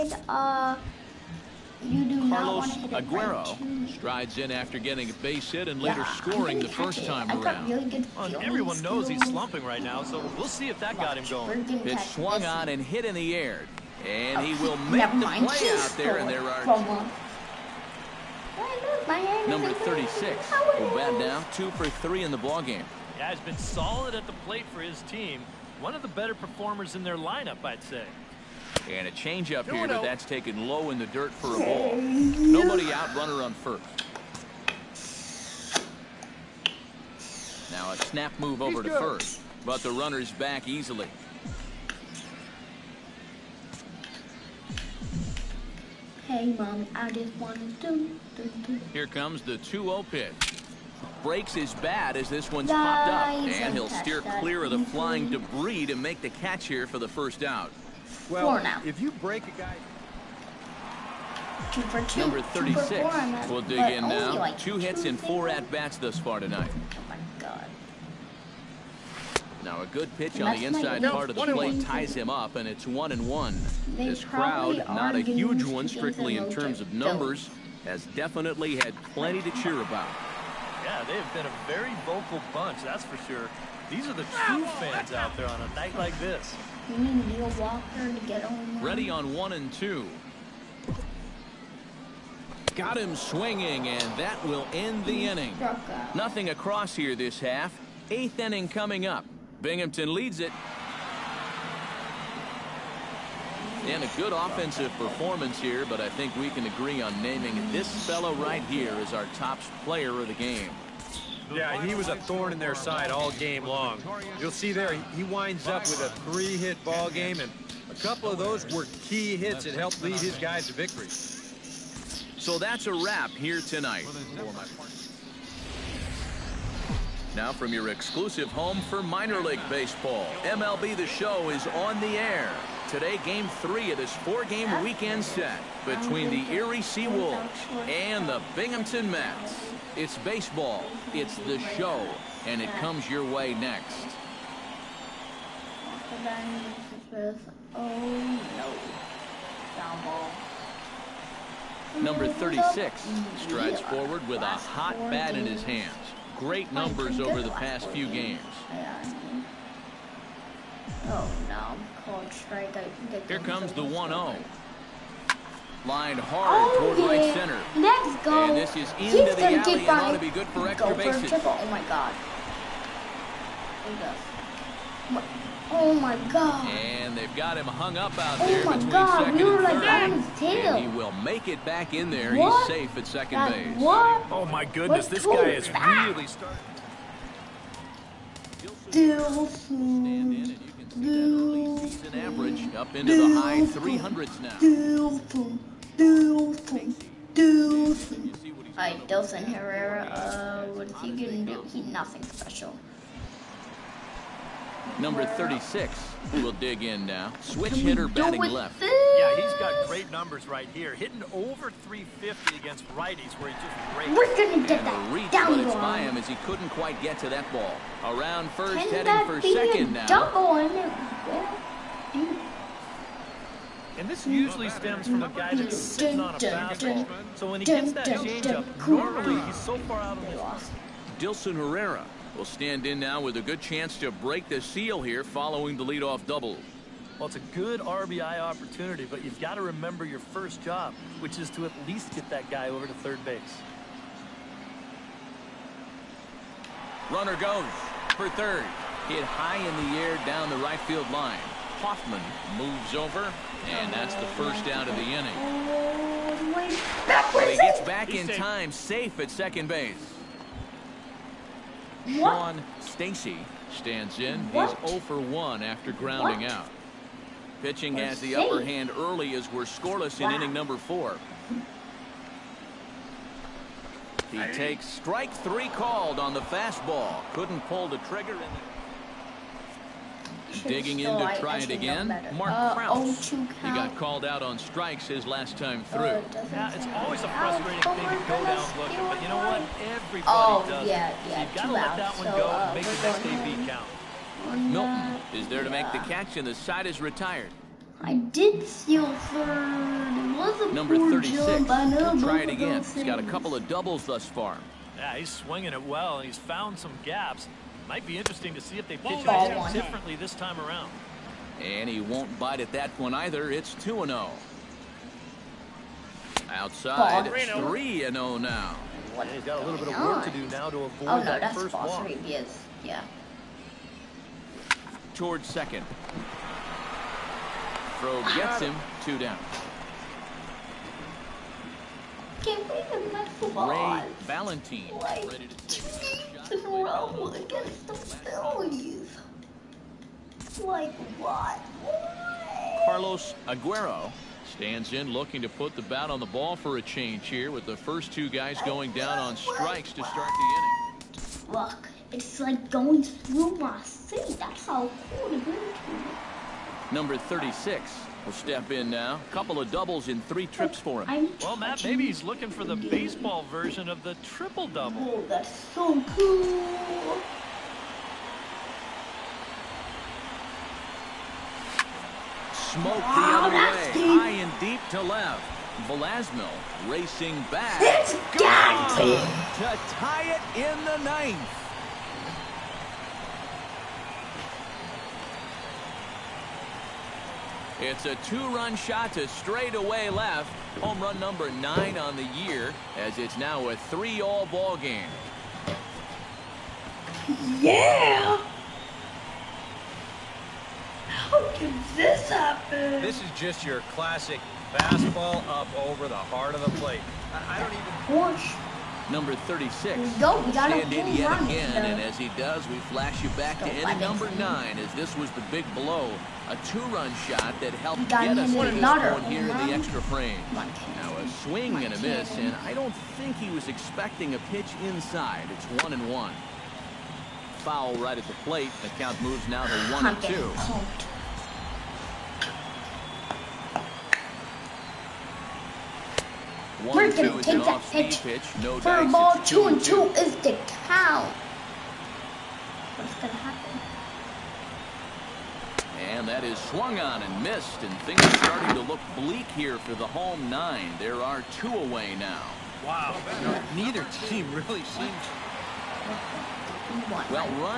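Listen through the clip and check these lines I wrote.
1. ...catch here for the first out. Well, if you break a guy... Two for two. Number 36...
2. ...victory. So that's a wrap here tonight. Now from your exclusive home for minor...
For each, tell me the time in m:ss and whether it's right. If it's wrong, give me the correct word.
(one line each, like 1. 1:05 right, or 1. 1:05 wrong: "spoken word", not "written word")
1. 0:56 right
2. 2:00 right.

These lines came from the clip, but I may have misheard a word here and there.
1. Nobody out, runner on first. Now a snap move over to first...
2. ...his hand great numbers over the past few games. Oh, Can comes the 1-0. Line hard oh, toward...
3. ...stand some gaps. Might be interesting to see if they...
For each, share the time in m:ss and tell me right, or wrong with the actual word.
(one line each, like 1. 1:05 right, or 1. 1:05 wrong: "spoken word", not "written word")
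1. 0:31 right
2. 2:35 wrong: "Here", not "Can"
3. 5:06 wrong: "found", not "stand".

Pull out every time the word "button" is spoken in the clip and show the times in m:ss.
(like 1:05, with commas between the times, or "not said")
not said.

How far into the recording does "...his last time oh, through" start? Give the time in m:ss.
4:45.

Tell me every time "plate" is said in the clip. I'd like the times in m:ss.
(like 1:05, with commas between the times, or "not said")
0:24, 1:11, 6:46, 7:08.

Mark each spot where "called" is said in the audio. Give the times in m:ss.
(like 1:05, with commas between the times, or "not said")
4:35, 4:43.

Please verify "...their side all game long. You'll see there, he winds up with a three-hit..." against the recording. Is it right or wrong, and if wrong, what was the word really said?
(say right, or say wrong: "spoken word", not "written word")
right.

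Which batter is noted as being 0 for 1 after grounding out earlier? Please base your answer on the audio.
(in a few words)
Sean Stacy.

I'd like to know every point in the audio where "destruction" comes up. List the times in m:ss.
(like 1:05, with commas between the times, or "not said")
not said.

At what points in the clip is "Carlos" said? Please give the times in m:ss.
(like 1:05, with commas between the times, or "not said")
0:02, 5:42.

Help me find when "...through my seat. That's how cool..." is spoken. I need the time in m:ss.
5:53.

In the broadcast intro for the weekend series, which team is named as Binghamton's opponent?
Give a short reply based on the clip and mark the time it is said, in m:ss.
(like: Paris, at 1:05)
Erie Seawolves, at 2:16.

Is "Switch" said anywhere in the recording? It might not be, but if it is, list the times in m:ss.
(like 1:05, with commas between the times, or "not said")
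3:27.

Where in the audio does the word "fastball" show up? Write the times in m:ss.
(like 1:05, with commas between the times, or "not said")
3:46, 4:36, 6:44.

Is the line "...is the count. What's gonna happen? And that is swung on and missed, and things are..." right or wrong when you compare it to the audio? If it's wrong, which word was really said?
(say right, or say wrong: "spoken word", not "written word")
right.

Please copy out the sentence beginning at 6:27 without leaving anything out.
It's a two-run shot to straightaway left.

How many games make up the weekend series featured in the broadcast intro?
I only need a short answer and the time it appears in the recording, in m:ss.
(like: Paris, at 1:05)
4, at 2:14.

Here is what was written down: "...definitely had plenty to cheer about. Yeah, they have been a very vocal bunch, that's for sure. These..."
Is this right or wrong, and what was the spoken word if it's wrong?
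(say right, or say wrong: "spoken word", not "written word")
right.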